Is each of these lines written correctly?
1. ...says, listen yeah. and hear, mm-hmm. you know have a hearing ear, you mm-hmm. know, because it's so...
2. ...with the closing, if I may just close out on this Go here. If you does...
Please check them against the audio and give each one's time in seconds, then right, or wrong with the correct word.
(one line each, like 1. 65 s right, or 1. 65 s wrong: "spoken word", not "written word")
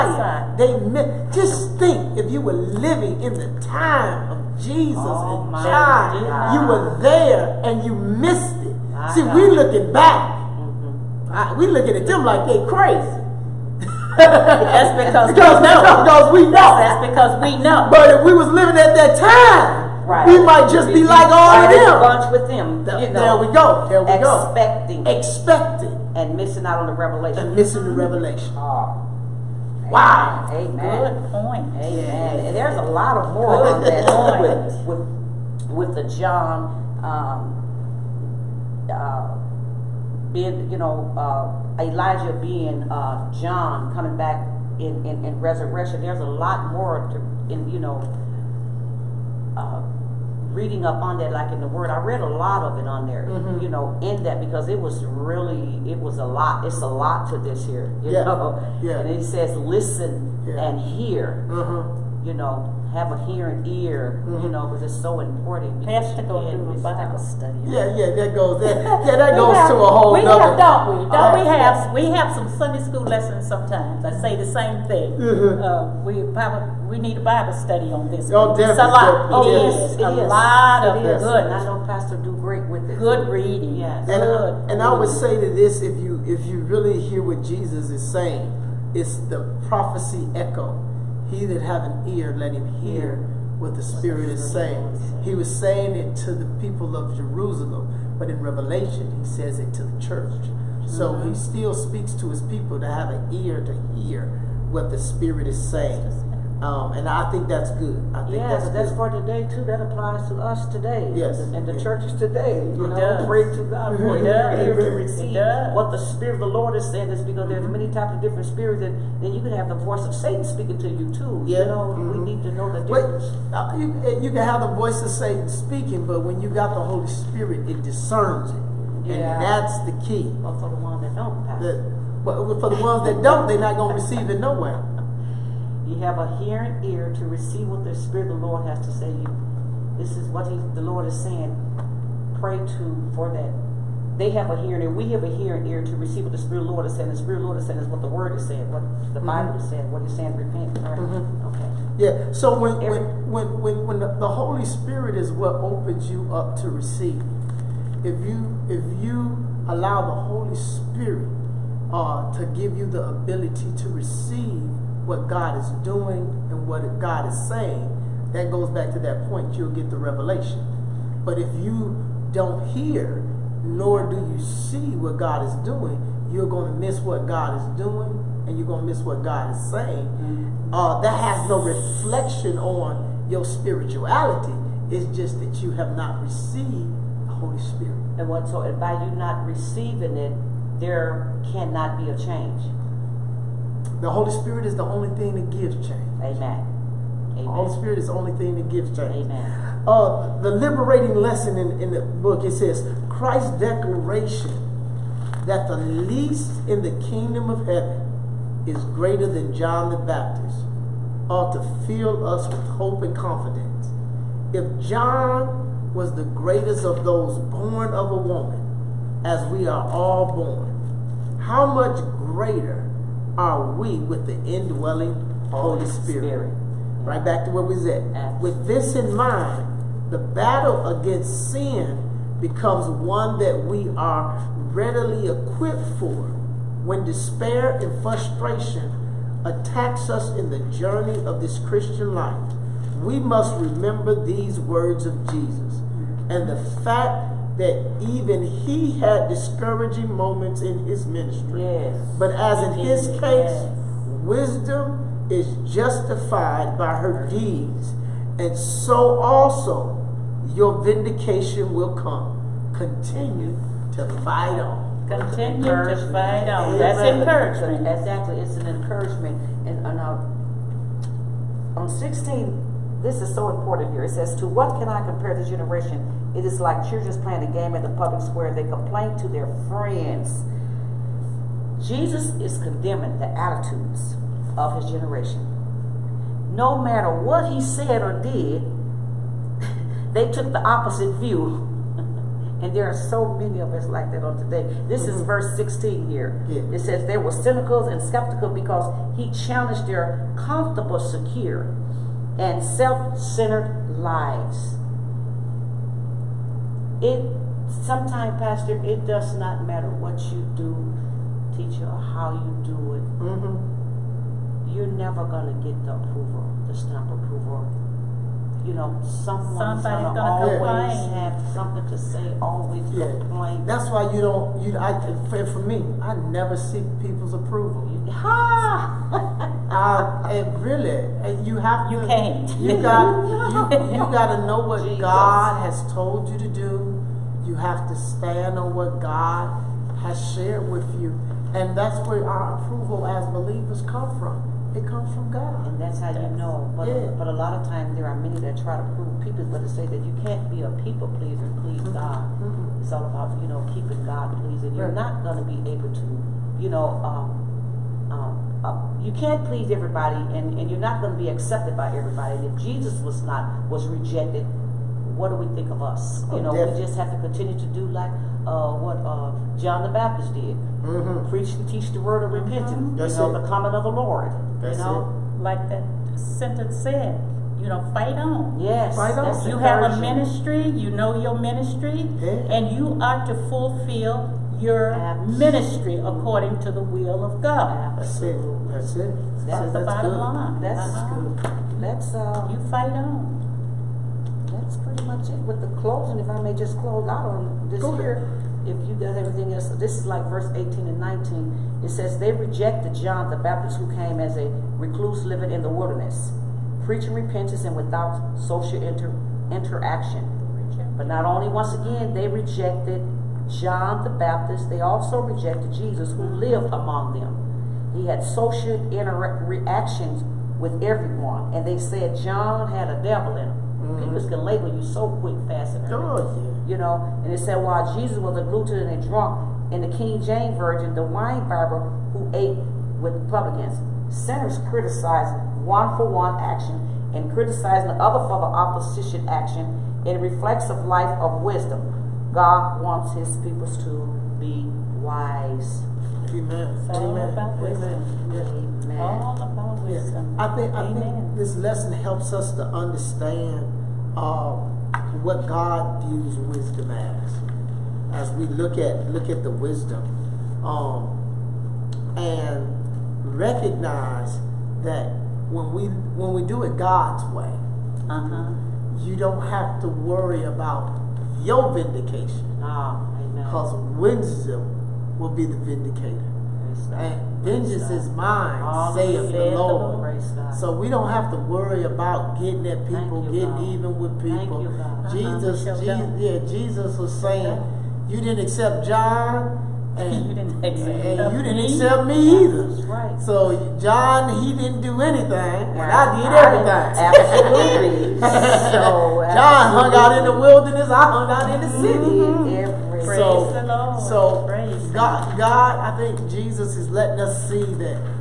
1. 59 s right
2. 395 s right.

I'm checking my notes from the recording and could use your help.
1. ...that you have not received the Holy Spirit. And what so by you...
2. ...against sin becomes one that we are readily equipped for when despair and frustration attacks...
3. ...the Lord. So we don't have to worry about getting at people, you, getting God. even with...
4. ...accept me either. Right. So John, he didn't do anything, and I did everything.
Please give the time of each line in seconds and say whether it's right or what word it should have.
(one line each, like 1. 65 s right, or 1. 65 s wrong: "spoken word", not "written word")
1. 185 s right
2. 230 s right
3. 479 s right
4. 491 s right.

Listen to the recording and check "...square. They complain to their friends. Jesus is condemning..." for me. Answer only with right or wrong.
right.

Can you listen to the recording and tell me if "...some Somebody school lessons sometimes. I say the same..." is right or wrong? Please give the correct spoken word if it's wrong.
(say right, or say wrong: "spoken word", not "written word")
wrong: "Sunday", not "Somebody".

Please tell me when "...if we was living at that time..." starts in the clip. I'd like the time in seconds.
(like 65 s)
18 s.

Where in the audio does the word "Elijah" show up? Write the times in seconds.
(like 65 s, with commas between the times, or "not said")
41 s.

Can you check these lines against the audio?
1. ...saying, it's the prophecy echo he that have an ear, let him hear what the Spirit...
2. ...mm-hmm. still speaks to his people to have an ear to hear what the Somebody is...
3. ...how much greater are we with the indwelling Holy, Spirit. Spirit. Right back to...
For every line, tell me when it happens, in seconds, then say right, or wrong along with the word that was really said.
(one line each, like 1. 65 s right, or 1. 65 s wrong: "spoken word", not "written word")
1. 88 s right
2. 101 s wrong: "Spirit", not "Somebody"
3. 221 s right.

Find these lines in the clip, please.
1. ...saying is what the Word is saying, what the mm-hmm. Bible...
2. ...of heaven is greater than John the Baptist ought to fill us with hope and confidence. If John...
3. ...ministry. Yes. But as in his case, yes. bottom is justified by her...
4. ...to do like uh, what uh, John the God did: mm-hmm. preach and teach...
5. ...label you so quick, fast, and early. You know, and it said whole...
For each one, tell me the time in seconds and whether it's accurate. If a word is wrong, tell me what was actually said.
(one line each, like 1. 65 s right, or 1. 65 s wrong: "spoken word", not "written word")
1. 147 s right
2. 207 s right
3. 251 s wrong: "wisdom", not "bottom"
4. 367 s wrong: "Baptist", not "God"
5. 424 s wrong: "while", not "whole".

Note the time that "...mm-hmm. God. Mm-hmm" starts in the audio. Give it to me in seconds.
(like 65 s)
351 s.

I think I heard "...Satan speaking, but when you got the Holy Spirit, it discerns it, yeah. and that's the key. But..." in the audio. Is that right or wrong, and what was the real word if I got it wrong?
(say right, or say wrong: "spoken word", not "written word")
right.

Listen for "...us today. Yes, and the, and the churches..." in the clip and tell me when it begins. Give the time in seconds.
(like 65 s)
110 s.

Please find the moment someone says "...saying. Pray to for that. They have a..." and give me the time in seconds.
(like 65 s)
141 s.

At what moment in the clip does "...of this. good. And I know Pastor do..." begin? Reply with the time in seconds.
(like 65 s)
80 s.